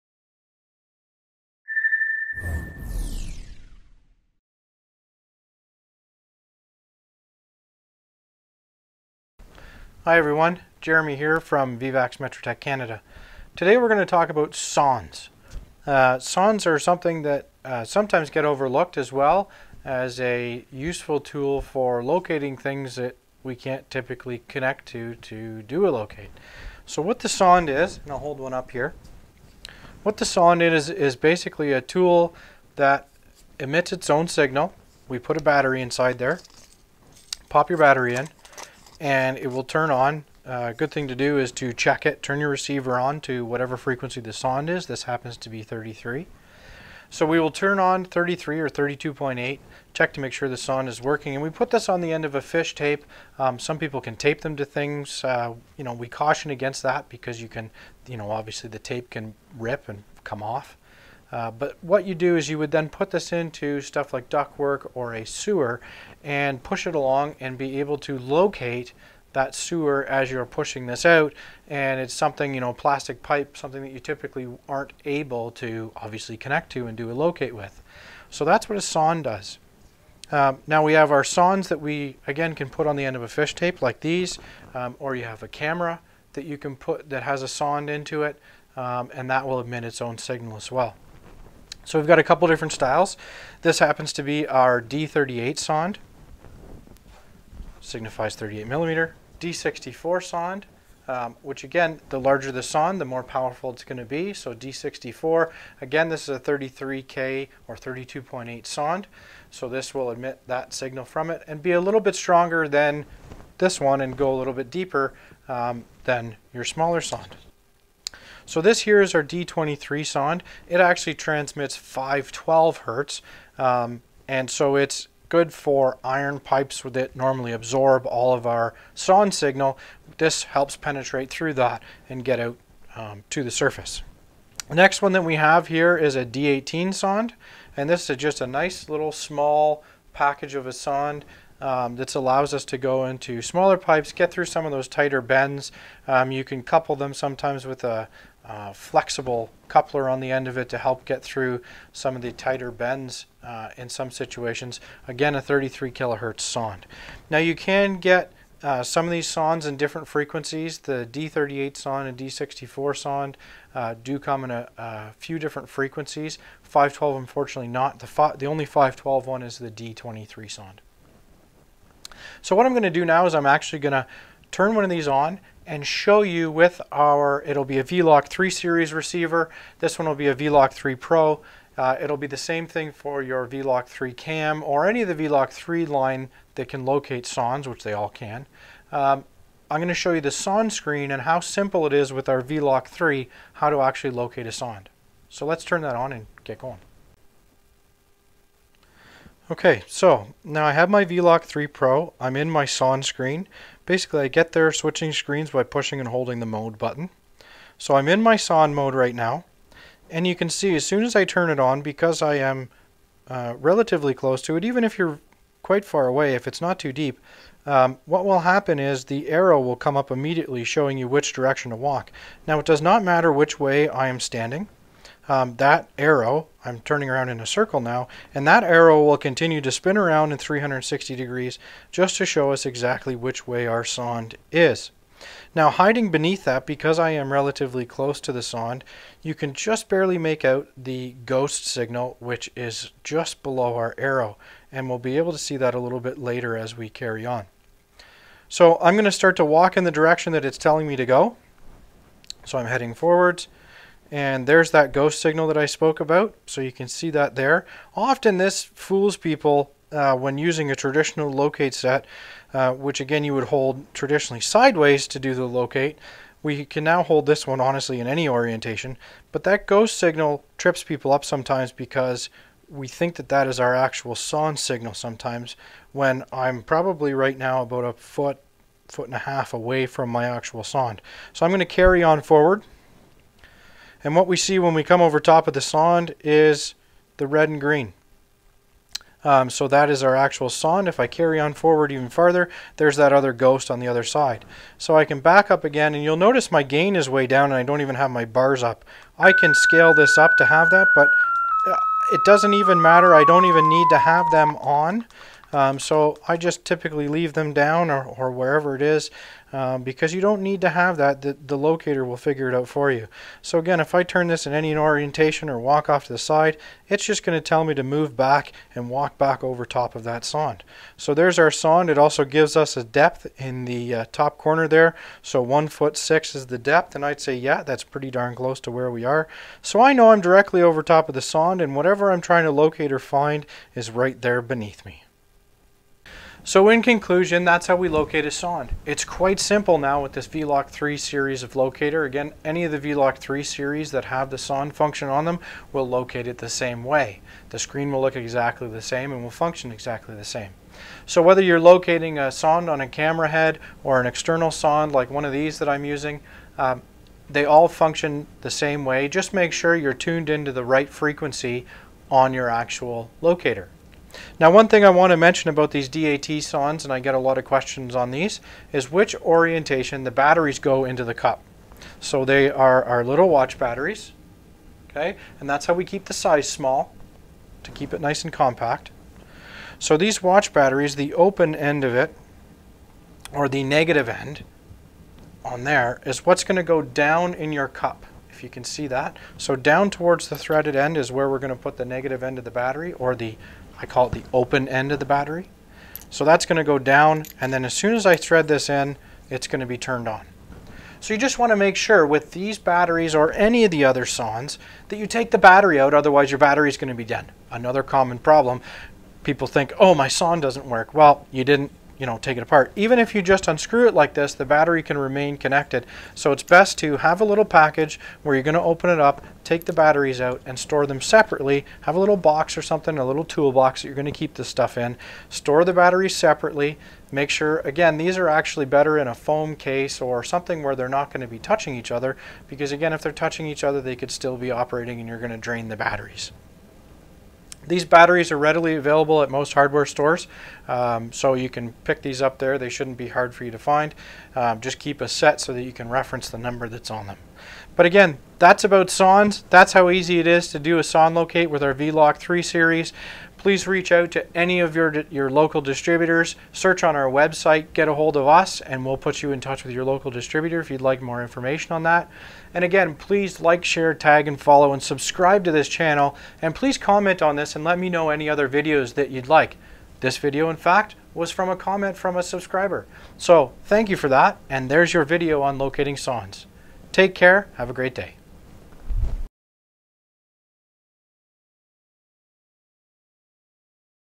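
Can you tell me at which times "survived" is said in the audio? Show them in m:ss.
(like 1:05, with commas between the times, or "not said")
not said.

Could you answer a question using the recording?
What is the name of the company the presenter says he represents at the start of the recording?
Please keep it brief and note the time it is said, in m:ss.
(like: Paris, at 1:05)
Vivax Metrotech Canada, at 0:11.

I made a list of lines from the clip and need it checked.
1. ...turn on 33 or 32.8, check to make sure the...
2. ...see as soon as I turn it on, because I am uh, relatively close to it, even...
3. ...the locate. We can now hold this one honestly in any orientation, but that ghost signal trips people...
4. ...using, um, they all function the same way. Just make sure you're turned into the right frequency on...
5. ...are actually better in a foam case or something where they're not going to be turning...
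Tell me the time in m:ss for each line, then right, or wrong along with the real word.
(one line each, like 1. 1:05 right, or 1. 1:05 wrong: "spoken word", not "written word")
1. 0:47 right
2. 3:30 right
3. 4:25 right
4. 5:55 wrong: "tuned", not "turned"
5. 7:08 wrong: "touching", not "turning".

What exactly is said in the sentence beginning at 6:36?
So that's going to go down and then as soon as I thread this in, it's going to be turned on.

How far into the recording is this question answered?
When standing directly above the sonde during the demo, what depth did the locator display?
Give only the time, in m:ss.
5:25.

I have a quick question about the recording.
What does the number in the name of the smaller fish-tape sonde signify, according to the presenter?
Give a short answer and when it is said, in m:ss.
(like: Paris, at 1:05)
38 millimeter, at 1:37.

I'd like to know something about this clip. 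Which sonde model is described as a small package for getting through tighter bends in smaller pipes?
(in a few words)
D18.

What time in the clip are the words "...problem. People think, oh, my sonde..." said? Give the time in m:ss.
6:48.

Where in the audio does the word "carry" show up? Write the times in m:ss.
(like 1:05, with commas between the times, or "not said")
4:06, 4:41, 4:51.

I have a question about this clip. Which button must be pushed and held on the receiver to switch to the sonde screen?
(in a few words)
mode button.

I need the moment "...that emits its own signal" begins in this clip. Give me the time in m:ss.
0:32.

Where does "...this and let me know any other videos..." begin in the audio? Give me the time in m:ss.
7:47.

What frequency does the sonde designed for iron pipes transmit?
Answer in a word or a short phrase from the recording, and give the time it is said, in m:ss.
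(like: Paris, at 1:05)
512 hertz, at 2:01.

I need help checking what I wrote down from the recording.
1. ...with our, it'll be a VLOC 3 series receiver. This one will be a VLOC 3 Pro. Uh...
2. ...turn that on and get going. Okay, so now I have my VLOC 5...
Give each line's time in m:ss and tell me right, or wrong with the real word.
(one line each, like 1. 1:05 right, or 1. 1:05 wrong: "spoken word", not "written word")
1. 2:56 right
2. 3:15 wrong: "3", not "5".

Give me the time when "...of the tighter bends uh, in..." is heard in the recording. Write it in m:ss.
2:32.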